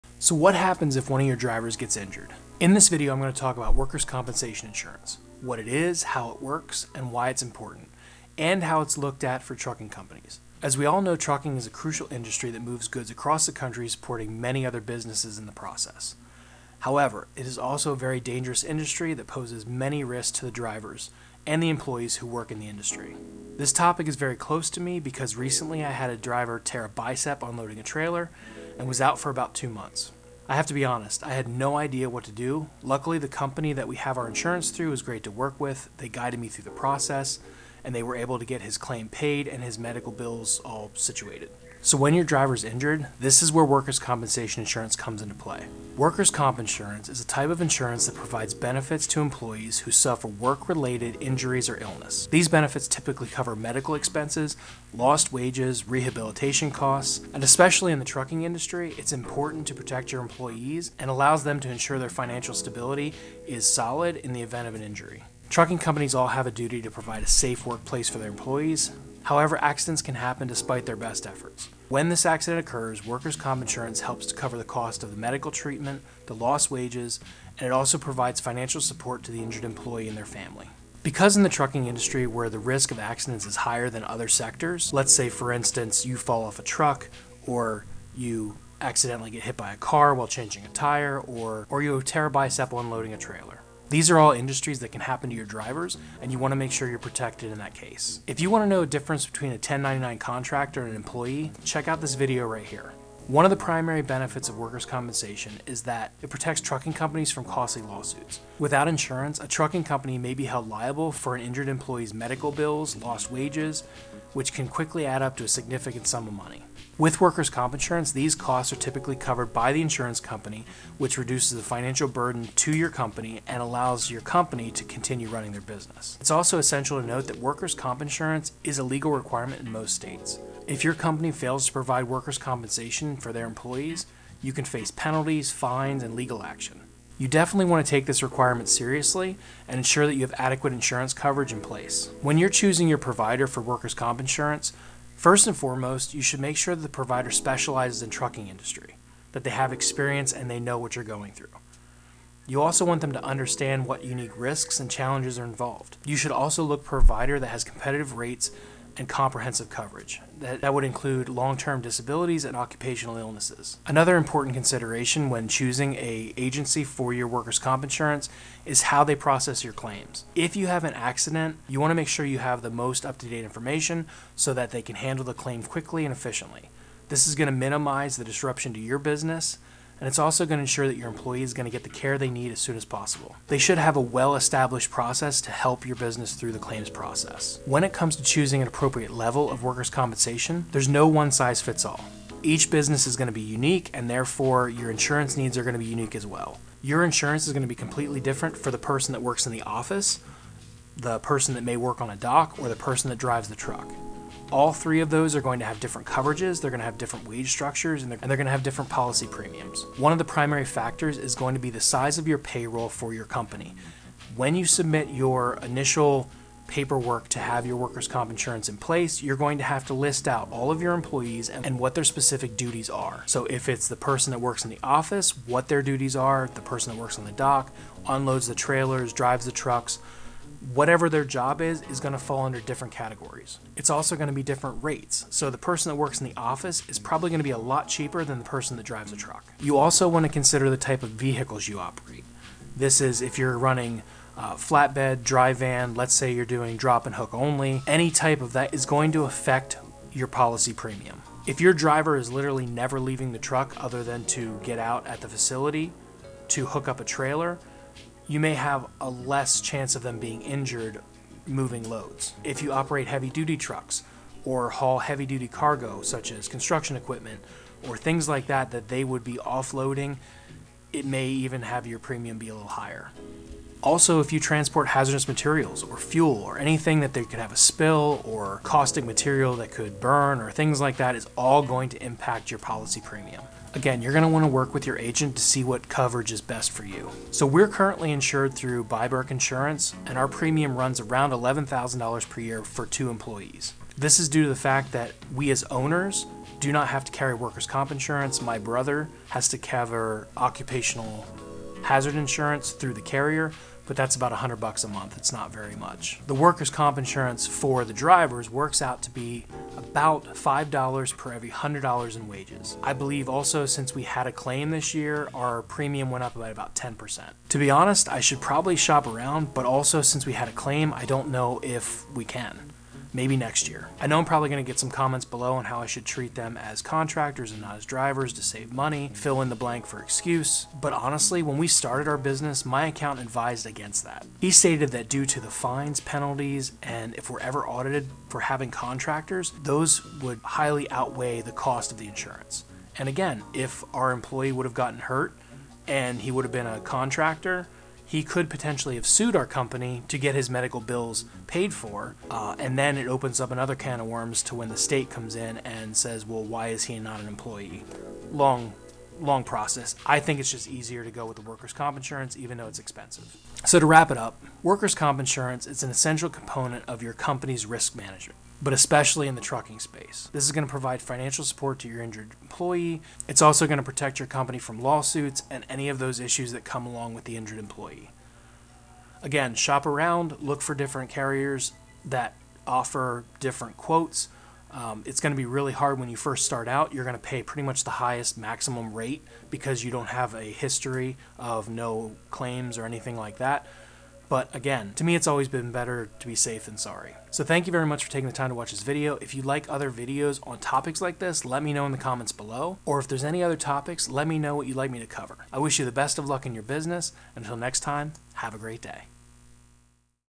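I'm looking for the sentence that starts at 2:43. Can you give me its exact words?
Another important consideration when choosing a agency for your workers' comp insurance is how they process your claims.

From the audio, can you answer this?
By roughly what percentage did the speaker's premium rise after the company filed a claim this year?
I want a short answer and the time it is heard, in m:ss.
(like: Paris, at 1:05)
10%, at 5:16.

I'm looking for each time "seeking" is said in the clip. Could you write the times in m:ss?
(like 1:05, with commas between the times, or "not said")
not said.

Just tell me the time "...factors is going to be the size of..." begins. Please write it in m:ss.
3:30.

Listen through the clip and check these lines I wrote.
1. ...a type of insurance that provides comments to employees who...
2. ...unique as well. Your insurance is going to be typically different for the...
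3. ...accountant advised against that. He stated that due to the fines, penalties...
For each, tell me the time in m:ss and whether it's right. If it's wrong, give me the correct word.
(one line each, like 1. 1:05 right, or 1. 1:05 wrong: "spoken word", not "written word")
1. 0:47 wrong: "benefits", not "comments"
2. 3:15 wrong: "completely", not "typically"
3. 5:32 right.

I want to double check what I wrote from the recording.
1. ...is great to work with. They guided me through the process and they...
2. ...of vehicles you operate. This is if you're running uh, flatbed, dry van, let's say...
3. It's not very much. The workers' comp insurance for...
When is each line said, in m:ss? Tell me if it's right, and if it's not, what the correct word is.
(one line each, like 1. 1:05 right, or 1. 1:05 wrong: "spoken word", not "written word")
1. 0:34 right
2. 4:01 right
3. 5:05 right.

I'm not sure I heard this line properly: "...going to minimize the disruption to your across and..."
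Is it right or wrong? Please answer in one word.
wrong.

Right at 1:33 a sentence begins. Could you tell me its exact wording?
These are all industries that can happen to your drivers, and you want to make sure you're protected in that case.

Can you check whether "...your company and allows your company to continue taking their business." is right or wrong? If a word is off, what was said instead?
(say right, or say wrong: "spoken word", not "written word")
wrong: "running", not "taking".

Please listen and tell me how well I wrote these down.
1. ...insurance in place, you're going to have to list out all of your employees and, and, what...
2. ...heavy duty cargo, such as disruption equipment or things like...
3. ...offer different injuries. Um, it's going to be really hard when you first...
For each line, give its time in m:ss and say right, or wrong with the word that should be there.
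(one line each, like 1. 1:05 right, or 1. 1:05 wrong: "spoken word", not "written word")
1. 3:38 right
2. 4:24 wrong: "construction", not "disruption"
3. 6:22 wrong: "quotes", not "injuries".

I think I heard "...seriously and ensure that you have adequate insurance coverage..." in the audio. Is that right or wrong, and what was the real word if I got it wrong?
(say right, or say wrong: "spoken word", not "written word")
right.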